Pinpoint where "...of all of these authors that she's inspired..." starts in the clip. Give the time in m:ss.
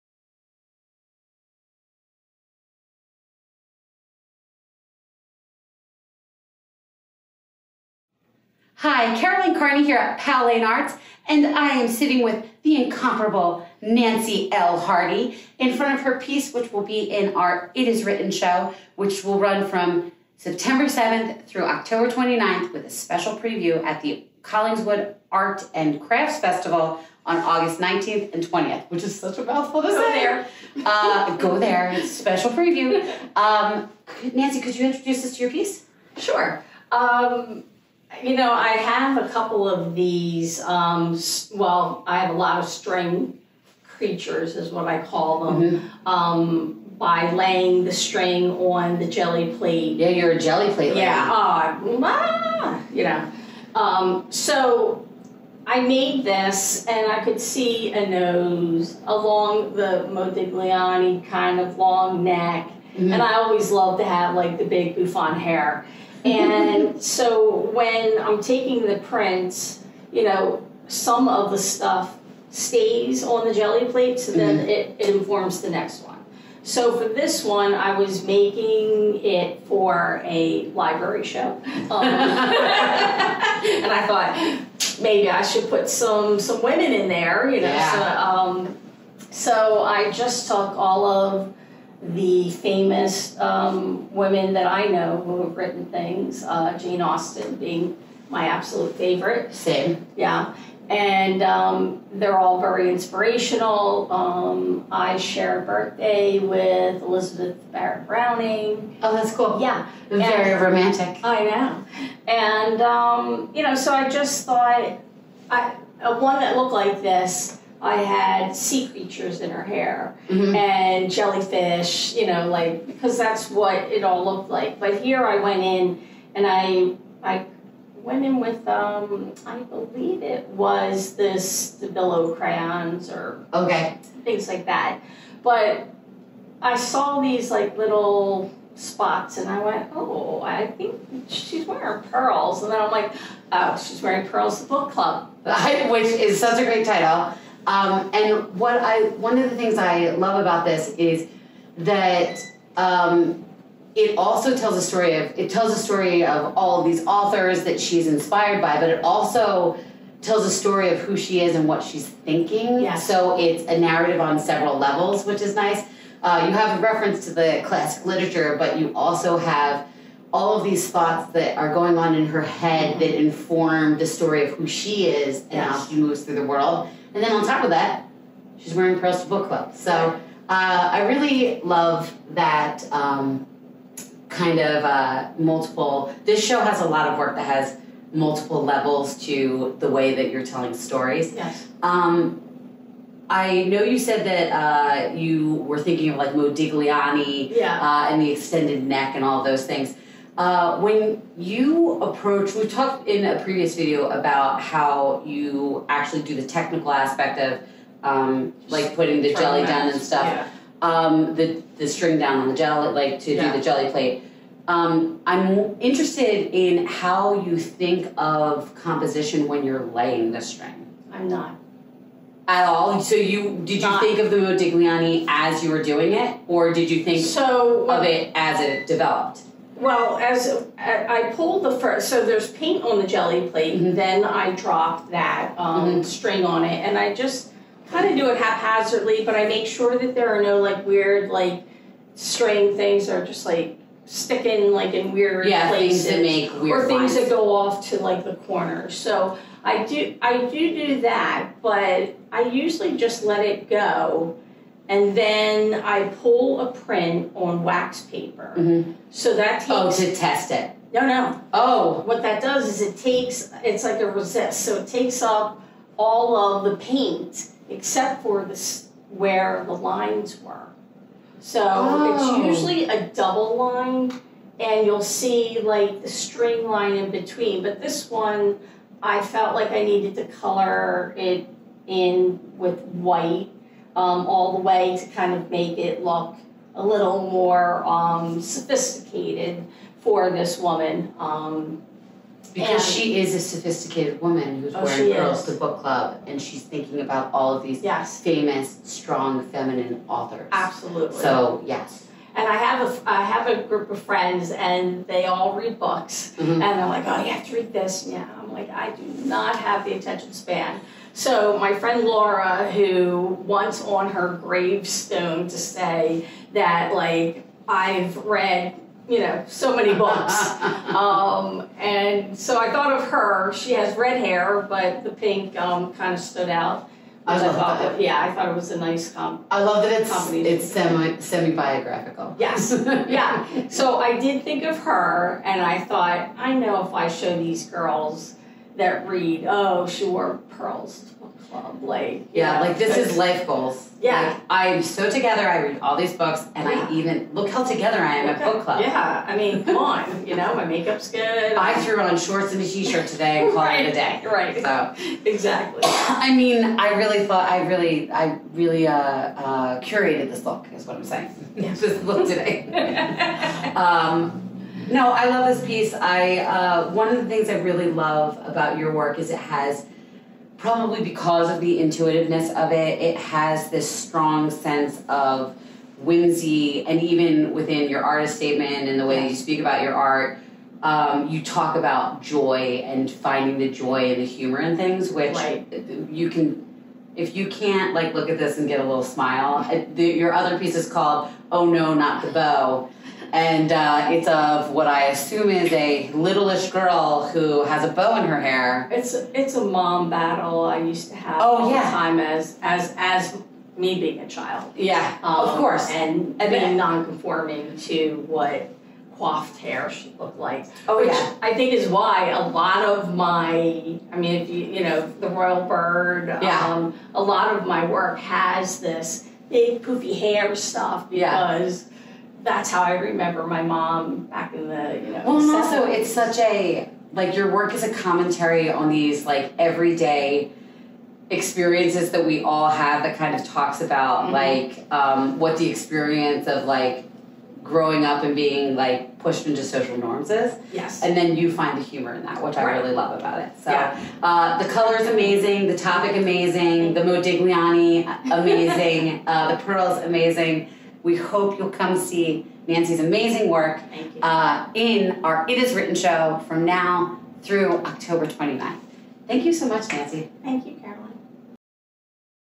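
2:36.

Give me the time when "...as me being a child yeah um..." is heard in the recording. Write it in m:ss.
6:42.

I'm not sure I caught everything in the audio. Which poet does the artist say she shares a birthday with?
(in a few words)
Elizabeth Barrett Browning.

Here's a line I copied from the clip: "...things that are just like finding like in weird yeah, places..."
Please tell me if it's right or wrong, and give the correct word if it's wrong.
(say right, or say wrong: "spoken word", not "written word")
wrong: "sticking", not "finding".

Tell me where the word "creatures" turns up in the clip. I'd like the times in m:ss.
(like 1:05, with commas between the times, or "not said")
0:43, 1:58.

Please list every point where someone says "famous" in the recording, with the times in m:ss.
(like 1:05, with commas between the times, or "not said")
1:32, 4:58.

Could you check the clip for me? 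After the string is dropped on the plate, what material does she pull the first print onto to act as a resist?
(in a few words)
Wax paper.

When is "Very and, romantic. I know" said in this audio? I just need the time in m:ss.
1:50.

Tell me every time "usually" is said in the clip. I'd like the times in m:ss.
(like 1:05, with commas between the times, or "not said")
4:12, 4:32.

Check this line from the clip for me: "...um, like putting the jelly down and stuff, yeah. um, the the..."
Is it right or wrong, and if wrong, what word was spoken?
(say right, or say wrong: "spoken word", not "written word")
right.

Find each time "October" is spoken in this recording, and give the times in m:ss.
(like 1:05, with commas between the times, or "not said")
0:21, 7:37.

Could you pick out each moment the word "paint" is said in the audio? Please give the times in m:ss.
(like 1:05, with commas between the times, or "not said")
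3:52, 4:26.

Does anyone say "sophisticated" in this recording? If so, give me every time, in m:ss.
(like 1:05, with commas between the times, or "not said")
4:48, 4:53.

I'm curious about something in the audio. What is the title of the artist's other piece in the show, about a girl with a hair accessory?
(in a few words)
Oh No Not the Bow.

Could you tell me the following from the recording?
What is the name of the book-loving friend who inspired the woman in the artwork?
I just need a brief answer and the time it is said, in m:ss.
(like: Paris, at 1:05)
Laura, at 5:12.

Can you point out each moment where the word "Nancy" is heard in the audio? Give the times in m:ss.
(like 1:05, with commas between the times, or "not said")
0:13, 0:34, 7:32, 7:39.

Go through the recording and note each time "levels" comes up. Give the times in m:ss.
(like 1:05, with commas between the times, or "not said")
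2:44, 3:08.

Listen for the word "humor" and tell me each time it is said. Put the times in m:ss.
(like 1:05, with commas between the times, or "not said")
6:24, 7:21.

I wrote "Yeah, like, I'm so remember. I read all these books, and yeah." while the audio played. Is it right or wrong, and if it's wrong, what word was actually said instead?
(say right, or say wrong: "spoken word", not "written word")
wrong: "together", not "remember".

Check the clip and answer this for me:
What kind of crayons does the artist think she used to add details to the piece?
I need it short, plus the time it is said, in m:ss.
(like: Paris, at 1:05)
Billow crayons, at 2:11.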